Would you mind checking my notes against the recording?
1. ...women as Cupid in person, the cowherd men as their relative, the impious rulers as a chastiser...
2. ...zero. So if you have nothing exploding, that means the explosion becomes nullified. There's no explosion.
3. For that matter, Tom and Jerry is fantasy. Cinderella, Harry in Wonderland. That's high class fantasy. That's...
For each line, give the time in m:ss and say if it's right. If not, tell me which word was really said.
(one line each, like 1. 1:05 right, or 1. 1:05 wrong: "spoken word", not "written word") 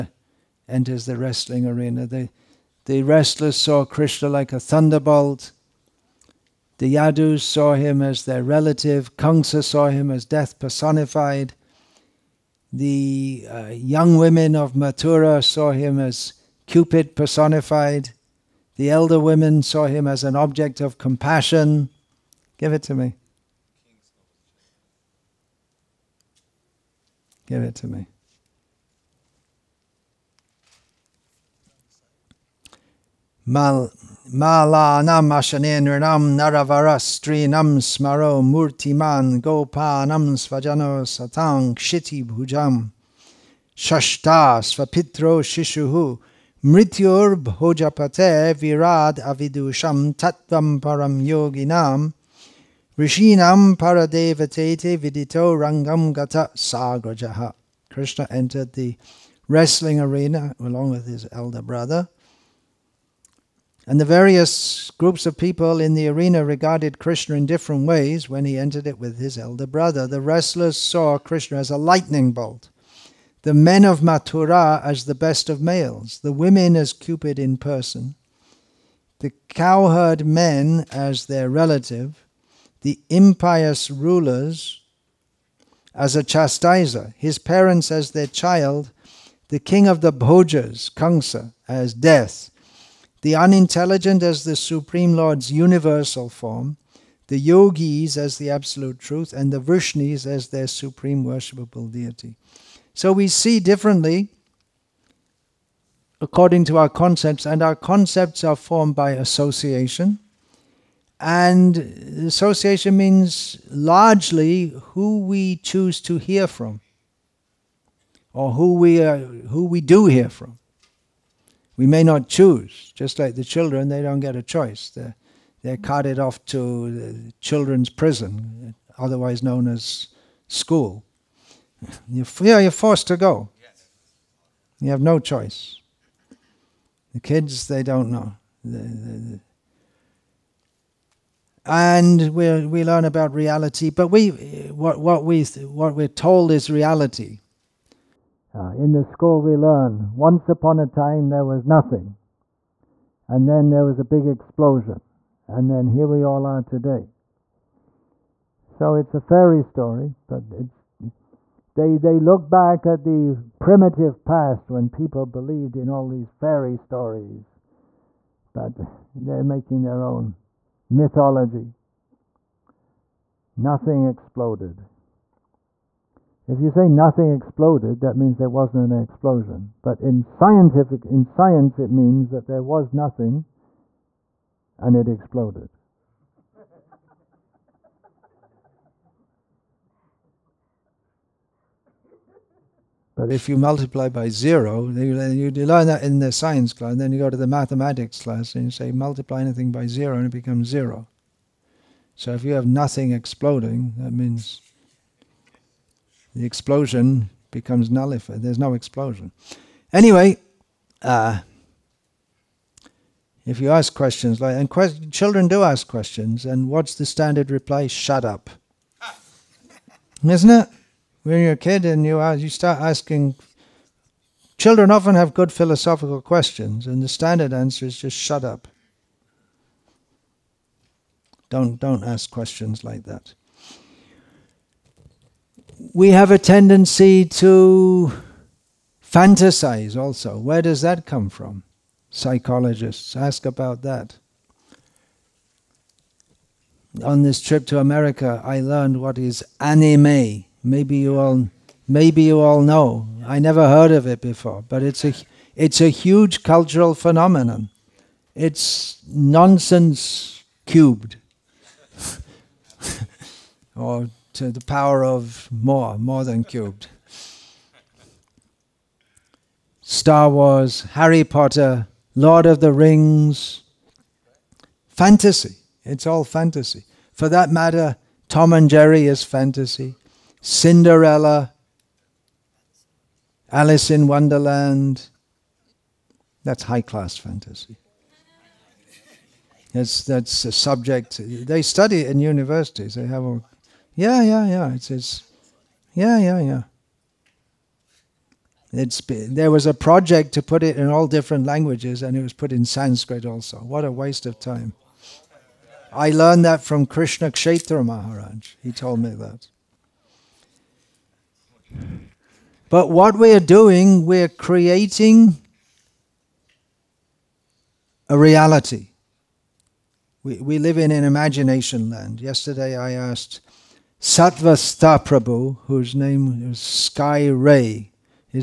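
1. 1:16 right
2. 3:20 right
3. 4:37 wrong: "Alice", not "Harry".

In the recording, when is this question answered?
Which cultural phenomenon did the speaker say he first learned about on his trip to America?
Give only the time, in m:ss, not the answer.
4:09.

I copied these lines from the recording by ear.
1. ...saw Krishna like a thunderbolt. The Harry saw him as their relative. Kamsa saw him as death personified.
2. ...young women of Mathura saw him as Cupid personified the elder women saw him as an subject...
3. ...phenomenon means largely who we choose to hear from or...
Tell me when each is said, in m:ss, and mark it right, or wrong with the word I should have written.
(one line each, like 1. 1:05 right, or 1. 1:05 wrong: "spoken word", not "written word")
1. 0:03 wrong: "Yadus", not "Harry"
2. 0:13 wrong: "object", not "subject"
3. 1:52 wrong: "association", not "phenomenon".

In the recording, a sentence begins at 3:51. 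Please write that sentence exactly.
Don't don't ask questions like that.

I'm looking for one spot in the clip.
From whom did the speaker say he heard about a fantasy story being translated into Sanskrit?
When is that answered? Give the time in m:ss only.
5:06.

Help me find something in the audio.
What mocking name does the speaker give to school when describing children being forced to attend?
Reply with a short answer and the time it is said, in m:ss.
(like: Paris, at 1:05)
Children's prison, at 2:07.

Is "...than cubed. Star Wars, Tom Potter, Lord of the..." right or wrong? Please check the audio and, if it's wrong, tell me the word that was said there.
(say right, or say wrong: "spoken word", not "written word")
wrong: "Harry", not "Tom".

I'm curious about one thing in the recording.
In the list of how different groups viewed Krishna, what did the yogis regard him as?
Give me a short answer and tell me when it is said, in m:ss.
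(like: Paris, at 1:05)
The absolute truth, at 1:38.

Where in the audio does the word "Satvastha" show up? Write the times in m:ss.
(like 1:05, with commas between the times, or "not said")
5:24.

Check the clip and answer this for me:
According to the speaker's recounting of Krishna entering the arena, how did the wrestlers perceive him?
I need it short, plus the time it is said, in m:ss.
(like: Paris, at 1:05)
A lightning bolt, at 1:11.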